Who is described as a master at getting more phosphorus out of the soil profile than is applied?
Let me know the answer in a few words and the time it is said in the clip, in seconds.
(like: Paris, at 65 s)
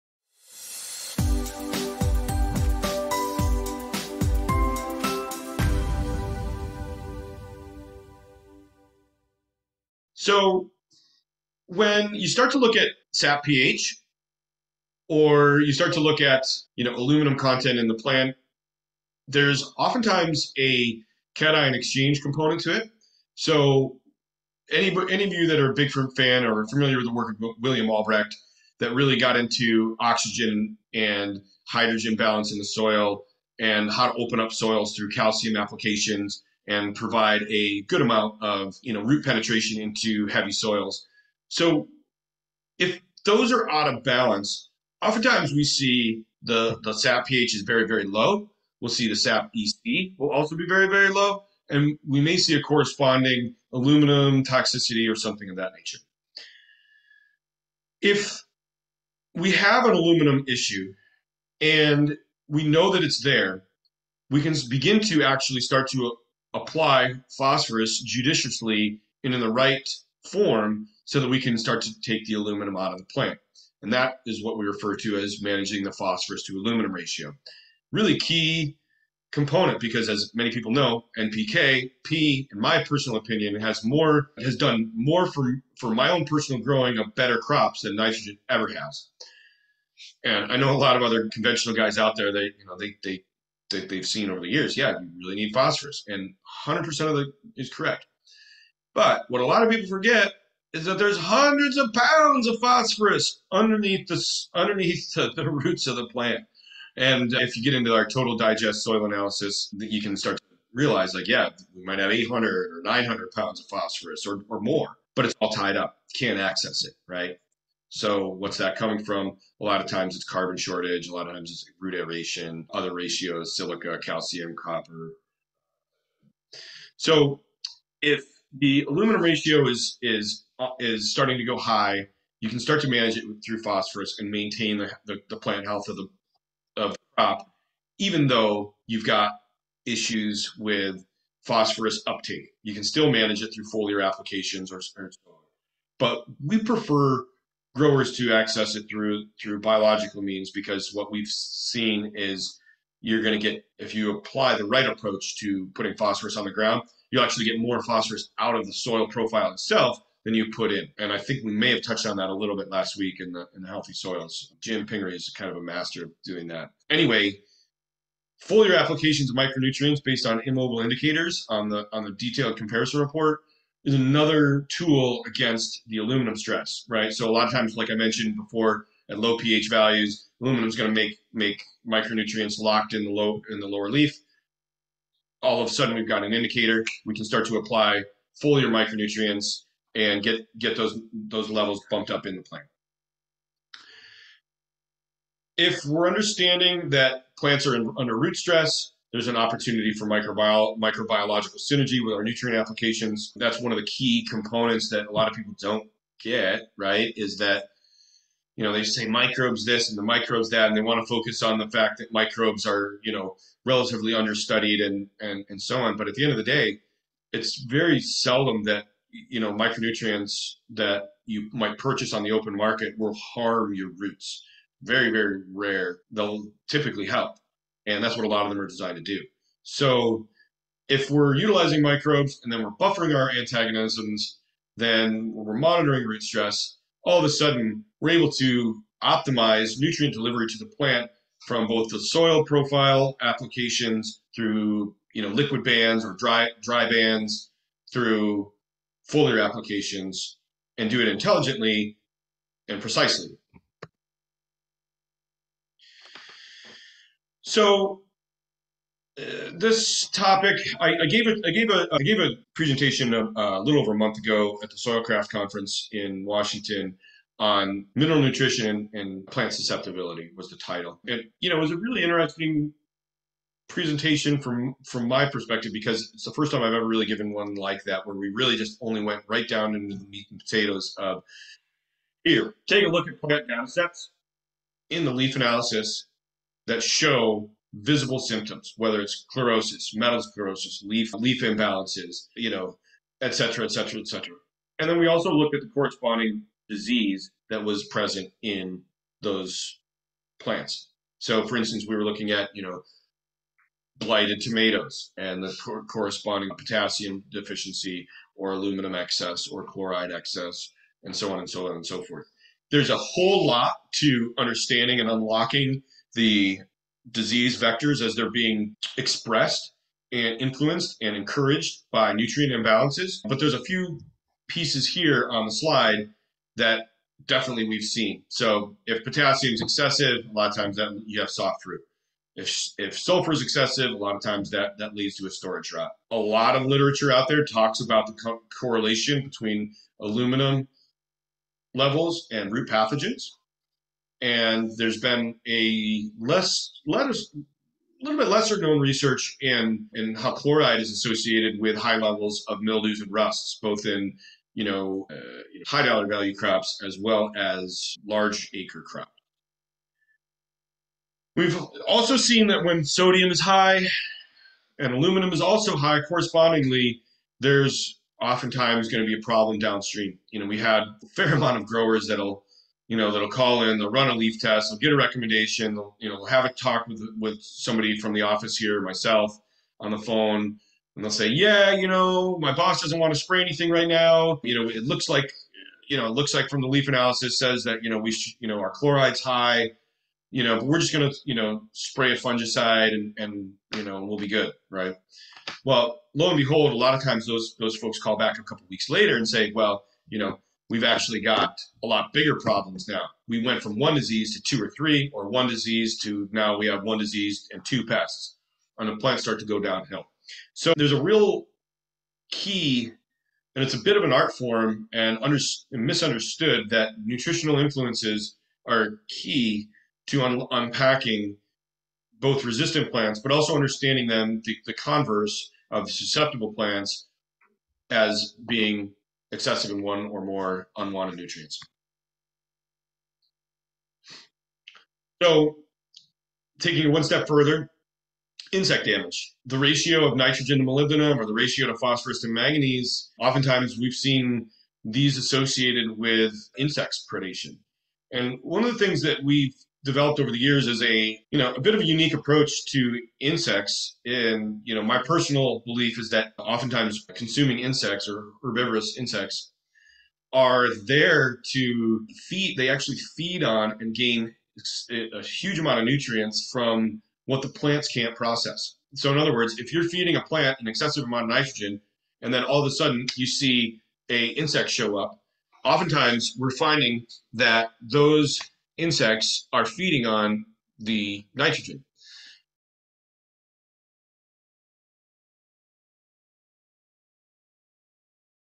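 Jim Pingree, at 164 s.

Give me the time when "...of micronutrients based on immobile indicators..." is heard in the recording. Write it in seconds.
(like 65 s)
169 s.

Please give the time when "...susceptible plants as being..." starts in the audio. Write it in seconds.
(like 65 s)
425 s.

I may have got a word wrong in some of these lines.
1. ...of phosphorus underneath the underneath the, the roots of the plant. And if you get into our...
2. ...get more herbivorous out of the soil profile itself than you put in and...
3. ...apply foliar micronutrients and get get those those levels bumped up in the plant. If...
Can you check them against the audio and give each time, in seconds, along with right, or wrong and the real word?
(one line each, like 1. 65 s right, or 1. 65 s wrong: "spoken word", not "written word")
1. 102 s right
2. 157 s wrong: "phosphorus", not "herbivorous"
3. 187 s right.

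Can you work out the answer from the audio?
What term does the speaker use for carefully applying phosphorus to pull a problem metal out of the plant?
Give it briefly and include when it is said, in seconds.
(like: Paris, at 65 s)
phosphorus to aluminum ratio, at 75 s.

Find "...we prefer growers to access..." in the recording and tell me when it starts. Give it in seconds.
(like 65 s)
146 s.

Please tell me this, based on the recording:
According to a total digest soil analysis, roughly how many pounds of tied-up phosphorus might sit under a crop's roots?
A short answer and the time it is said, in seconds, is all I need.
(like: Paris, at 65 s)
800 or 900 pounds, at 112 s.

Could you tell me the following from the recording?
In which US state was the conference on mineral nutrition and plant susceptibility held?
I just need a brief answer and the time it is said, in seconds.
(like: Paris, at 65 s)
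Washington, at 266 s.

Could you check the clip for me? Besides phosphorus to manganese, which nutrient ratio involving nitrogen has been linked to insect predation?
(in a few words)
nitrogen to molybdenum.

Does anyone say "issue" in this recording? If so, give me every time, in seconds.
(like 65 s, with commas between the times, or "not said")
60 s, 139 s.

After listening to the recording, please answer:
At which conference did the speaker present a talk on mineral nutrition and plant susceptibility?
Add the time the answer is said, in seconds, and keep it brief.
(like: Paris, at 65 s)
Soilcraft Conference, at 264 s.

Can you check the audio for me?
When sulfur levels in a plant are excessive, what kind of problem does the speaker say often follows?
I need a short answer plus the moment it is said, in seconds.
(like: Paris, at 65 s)
storage rot, at 335 s.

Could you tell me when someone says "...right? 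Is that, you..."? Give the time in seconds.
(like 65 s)
206 s.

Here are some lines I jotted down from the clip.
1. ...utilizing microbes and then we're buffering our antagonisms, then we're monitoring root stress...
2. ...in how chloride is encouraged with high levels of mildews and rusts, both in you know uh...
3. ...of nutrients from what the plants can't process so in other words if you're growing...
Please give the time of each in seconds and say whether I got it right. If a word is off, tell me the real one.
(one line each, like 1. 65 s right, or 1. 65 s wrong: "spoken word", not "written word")
1. 231 s right
2. 349 s wrong: "associated", not "encouraged"
3. 465 s wrong: "feeding", not "growing".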